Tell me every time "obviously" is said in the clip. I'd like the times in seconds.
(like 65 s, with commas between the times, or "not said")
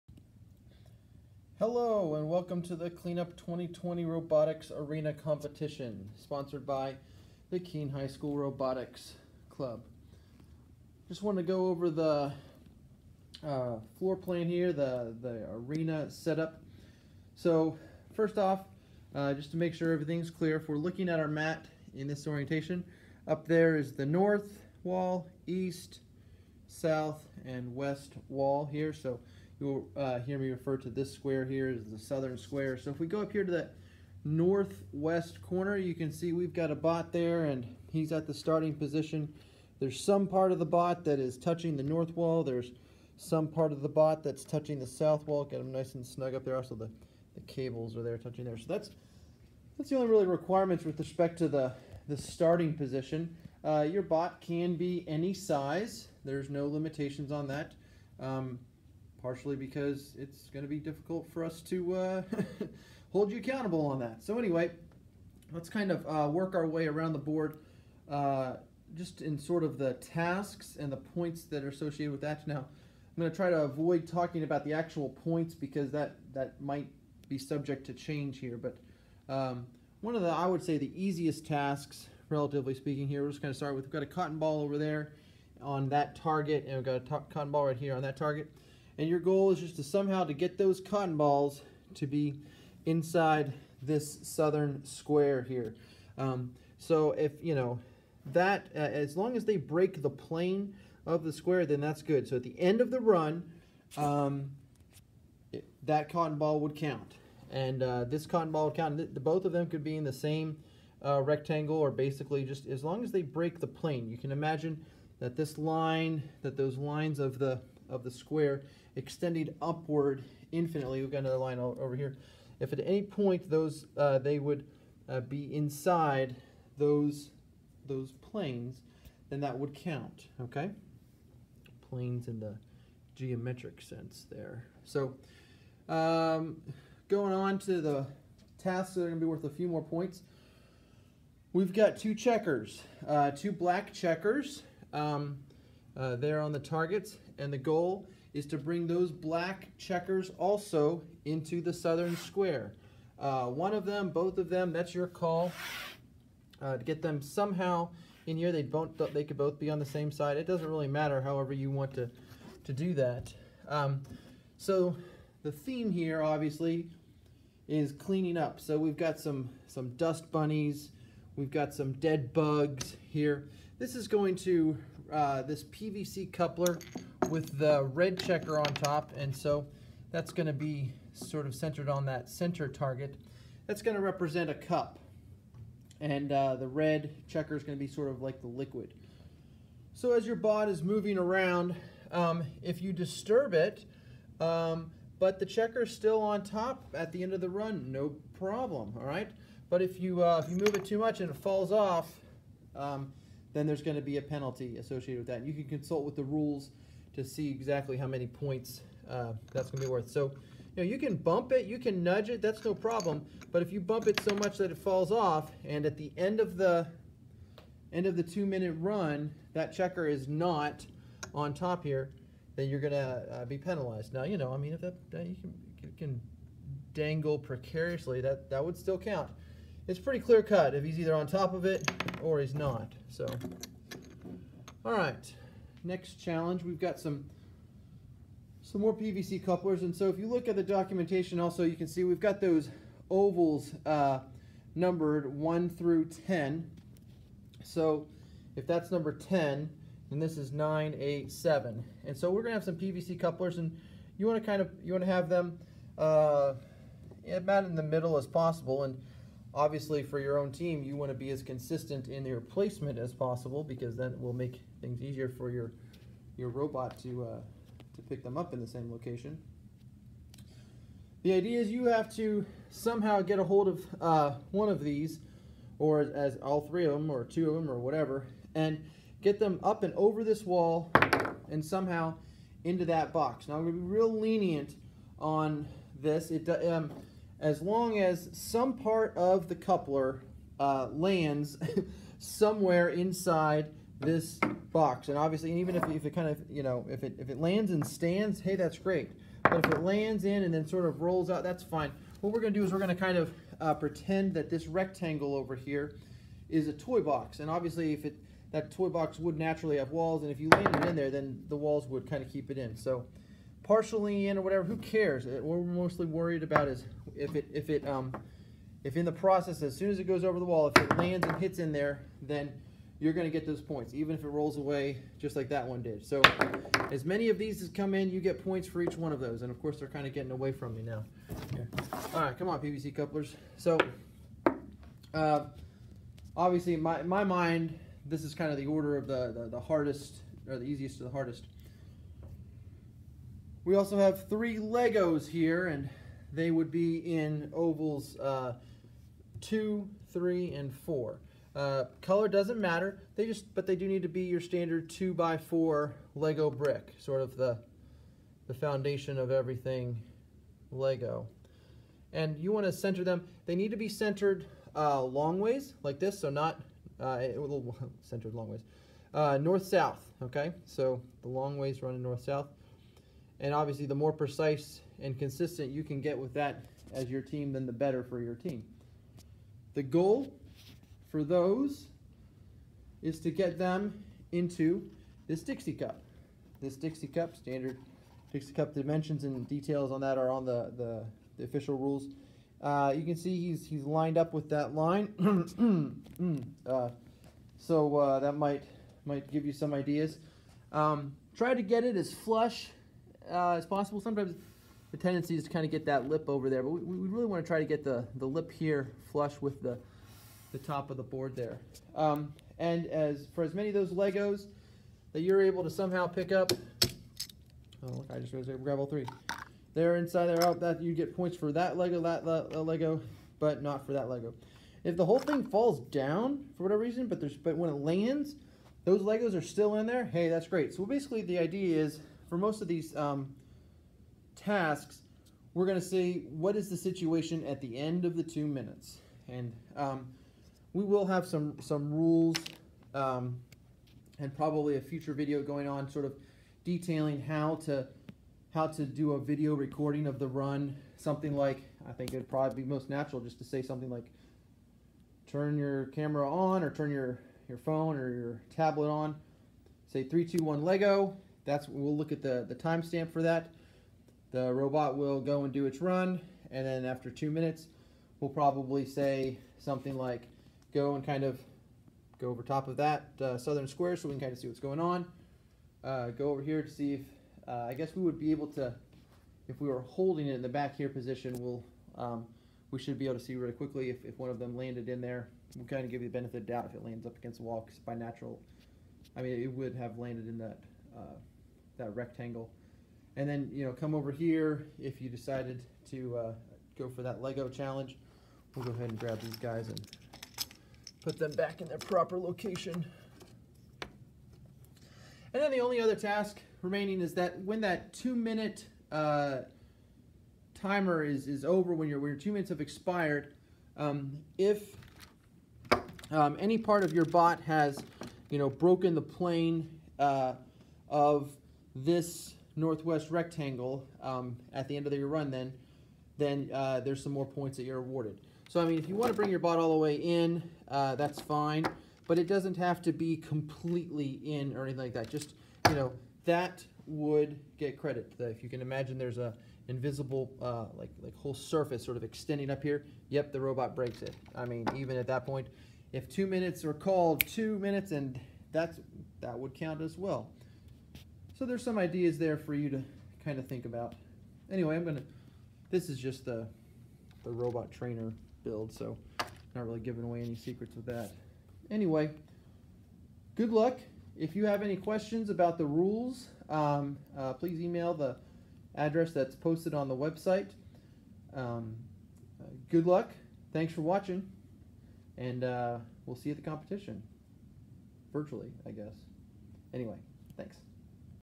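166 s, 259 s, 295 s, 307 s, 336 s, 373 s.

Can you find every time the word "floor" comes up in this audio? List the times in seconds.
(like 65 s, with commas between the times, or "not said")
13 s.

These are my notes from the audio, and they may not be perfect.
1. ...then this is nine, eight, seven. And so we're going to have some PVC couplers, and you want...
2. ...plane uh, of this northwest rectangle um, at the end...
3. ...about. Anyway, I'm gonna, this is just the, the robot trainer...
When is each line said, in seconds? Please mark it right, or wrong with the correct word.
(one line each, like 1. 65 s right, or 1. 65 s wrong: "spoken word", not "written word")
1. 250 s right
2. 519 s right
3. 553 s right.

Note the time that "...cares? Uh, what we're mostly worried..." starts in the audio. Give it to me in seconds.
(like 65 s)
314 s.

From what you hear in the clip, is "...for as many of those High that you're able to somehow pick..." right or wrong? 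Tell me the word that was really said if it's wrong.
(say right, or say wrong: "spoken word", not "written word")
wrong: "Legos", not "High".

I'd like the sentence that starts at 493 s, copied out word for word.
And then, you know, come over here if you decided to uh, go for that Lego challenge.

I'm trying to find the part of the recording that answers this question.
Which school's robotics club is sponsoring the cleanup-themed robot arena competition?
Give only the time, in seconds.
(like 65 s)
7 s.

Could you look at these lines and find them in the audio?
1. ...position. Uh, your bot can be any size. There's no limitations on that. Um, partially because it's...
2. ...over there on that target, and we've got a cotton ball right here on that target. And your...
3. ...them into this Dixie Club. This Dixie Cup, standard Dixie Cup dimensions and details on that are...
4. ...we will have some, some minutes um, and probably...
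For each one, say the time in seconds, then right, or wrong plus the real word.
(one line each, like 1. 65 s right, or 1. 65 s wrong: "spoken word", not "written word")
1. 52 s right
2. 84 s right
3. 383 s wrong: "Cup", not "Club"
4. 440 s wrong: "rules", not "minutes".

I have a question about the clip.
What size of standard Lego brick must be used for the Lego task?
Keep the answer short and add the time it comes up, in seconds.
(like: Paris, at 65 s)
2 by 4, at 354 s.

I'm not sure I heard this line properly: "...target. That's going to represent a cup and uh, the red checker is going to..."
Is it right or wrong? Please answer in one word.
right.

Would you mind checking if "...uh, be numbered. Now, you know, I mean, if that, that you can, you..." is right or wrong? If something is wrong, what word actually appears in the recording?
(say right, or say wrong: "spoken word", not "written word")
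wrong: "penalized", not "numbered".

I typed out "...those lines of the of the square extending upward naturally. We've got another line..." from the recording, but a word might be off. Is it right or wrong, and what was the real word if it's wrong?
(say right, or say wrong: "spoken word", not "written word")
wrong: "infinitely", not "naturally".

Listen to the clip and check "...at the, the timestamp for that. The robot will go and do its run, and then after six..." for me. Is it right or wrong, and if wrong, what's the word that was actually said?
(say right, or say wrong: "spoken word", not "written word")
wrong: "two", not "six".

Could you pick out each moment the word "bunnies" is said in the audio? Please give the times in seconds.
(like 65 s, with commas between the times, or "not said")
170 s.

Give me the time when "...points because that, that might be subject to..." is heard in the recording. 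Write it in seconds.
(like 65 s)
75 s.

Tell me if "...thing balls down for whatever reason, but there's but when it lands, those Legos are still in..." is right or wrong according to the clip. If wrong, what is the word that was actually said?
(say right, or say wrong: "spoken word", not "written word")
wrong: "falls", not "balls".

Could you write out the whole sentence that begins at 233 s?
So, all right, next challenge, we've got some some more PVC couplers.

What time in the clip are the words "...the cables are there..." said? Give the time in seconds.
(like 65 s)
47 s.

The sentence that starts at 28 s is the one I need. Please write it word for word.
So You'll uh, hear me refer to this square here as the southern square.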